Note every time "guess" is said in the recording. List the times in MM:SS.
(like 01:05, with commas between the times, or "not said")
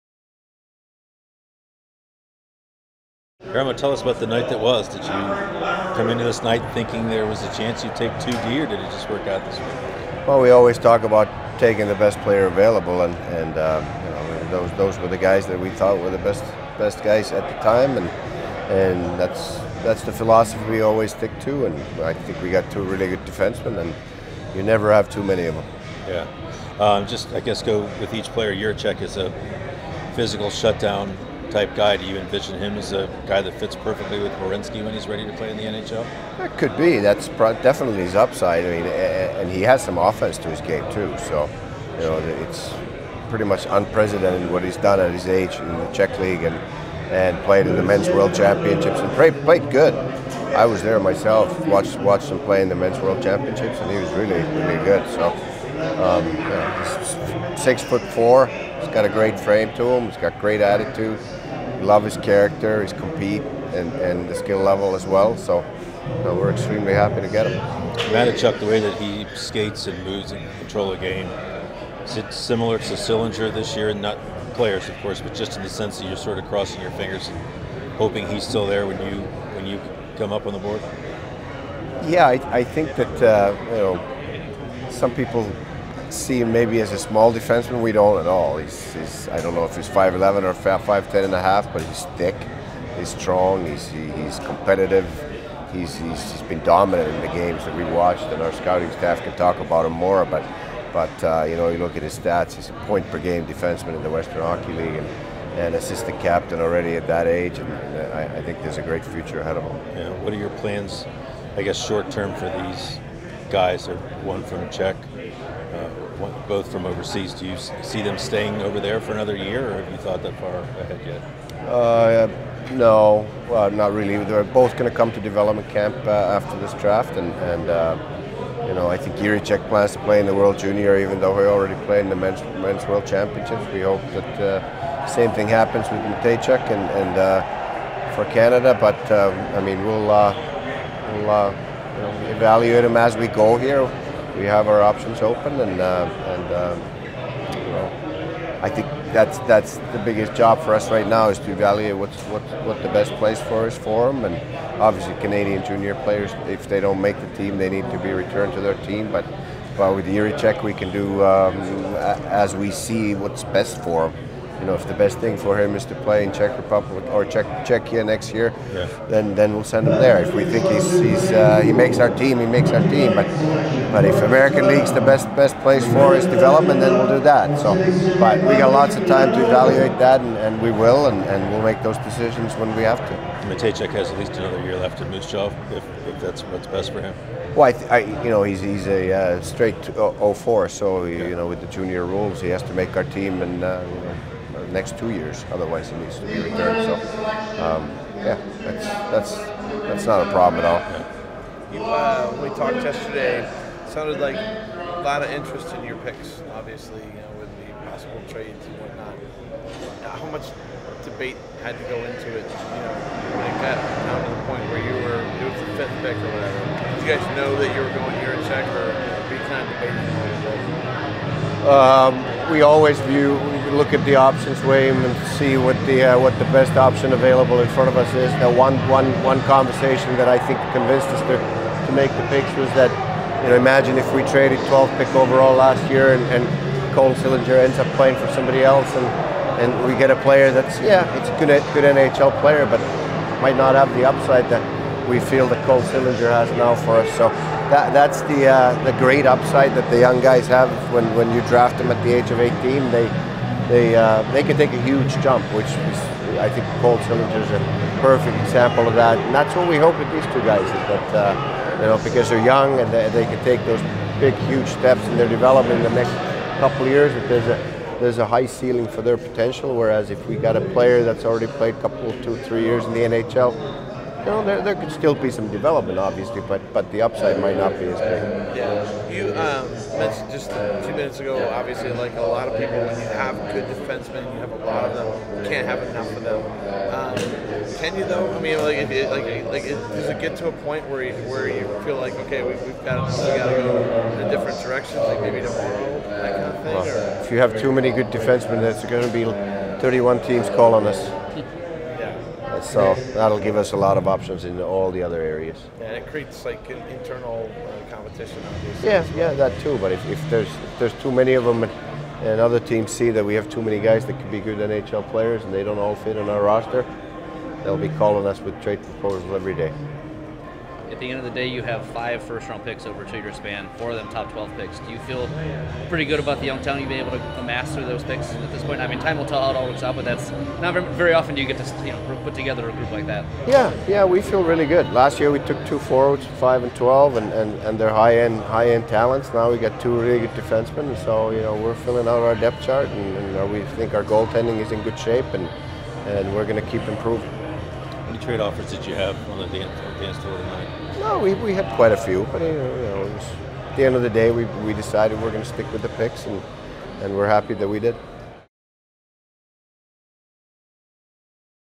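00:27, 01:51.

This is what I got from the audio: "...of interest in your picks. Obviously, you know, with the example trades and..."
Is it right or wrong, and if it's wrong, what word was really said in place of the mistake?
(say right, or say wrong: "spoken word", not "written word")
wrong: "possible", not "example".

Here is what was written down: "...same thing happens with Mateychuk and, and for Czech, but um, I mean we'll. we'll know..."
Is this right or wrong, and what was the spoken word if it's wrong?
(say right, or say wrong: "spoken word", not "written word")
wrong: "Canada", not "Czech".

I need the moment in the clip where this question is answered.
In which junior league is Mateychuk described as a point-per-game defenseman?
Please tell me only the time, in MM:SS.
01:44.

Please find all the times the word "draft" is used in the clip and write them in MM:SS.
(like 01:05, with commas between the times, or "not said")
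02:06, 04:11.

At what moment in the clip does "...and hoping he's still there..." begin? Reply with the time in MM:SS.
01:17.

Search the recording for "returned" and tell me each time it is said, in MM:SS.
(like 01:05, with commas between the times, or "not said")
02:38, 03:16.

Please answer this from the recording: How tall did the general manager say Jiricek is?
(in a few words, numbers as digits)
6'4".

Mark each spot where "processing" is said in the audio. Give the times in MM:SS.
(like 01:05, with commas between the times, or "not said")
not said.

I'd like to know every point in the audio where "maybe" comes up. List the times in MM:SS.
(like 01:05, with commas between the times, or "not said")
01:26, 04:55.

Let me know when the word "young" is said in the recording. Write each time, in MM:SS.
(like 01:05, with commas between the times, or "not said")
04:09, 04:22, 05:26.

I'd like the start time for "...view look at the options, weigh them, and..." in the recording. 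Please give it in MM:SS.
03:43.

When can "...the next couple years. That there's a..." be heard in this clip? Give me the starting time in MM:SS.
04:25.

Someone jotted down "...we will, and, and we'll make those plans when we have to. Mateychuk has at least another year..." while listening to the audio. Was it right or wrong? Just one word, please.
wrong.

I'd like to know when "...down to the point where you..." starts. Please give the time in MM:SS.
03:33.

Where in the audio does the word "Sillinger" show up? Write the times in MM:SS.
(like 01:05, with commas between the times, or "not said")
01:12, 03:57, 04:05.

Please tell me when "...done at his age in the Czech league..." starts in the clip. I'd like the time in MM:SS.
00:44.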